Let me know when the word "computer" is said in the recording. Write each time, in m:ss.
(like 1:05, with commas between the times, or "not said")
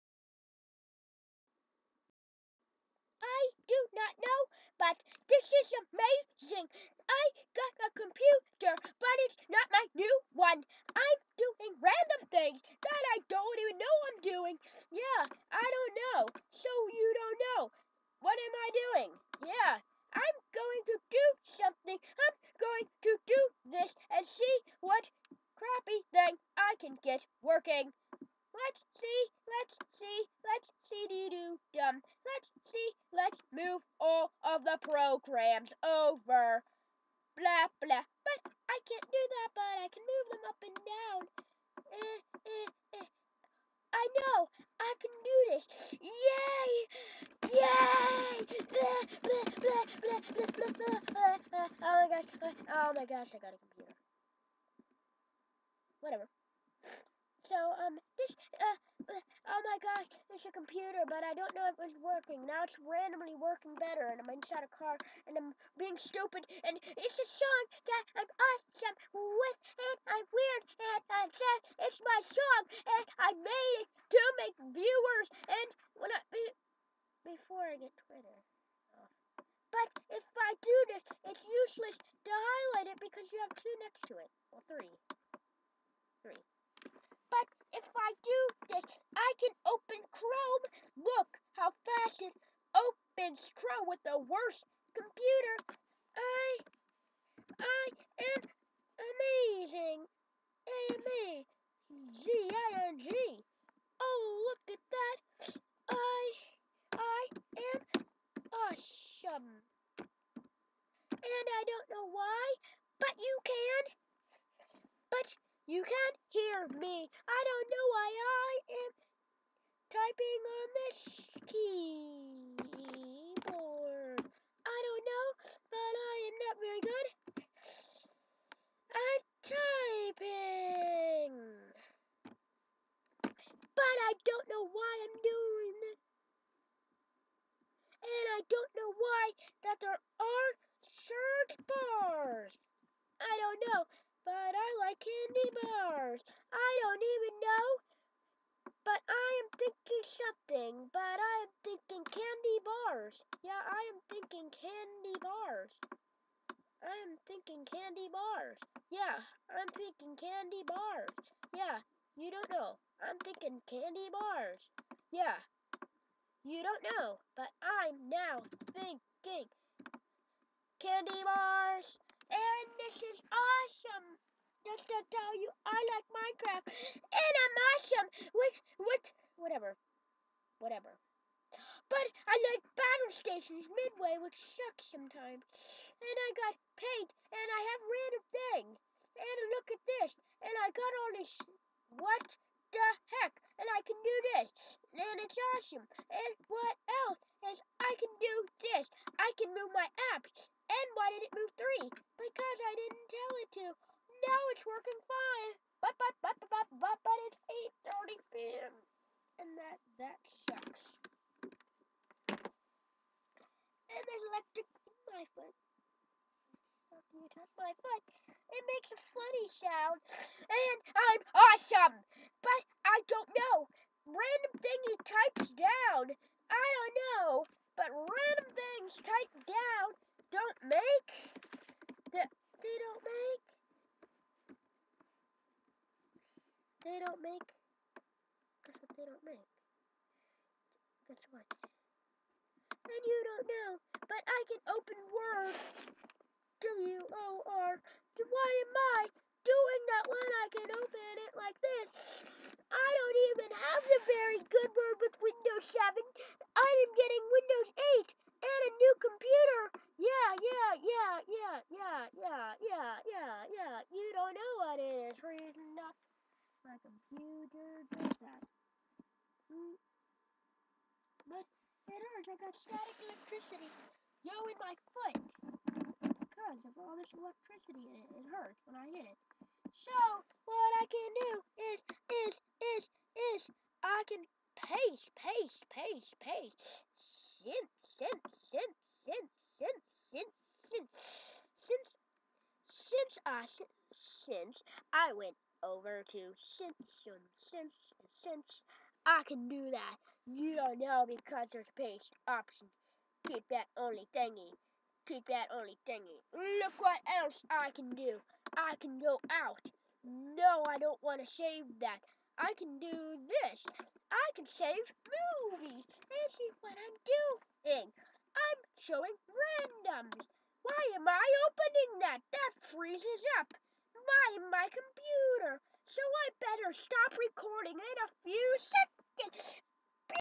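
0:07, 0:53, 1:00, 1:34, 4:19, 4:26, 5:24.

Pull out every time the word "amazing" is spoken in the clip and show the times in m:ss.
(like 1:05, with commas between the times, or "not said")
0:05, 1:39.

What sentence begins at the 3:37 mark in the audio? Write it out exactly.
you touch my it makes a funny sound, and I'm awesome.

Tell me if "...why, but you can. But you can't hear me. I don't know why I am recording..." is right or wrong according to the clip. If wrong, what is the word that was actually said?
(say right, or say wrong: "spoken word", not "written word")
wrong: "typing", not "recording".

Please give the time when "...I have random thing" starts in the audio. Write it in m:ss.
3:07.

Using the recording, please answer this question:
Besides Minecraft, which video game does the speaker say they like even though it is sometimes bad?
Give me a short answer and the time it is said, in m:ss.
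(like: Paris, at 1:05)
Battlestations Midway, at 3:02.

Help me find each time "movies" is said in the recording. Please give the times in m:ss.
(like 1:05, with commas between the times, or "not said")
5:15.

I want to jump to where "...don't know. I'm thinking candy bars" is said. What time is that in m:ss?
2:42.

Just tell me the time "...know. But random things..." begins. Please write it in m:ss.
3:46.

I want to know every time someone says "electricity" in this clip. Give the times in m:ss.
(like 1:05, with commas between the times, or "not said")
4:33, 4:37.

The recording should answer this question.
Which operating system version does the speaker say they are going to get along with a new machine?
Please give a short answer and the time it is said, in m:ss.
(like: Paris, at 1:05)
Windows 8, at 4:17.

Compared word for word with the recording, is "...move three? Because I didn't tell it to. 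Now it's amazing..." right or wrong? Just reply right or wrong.
wrong.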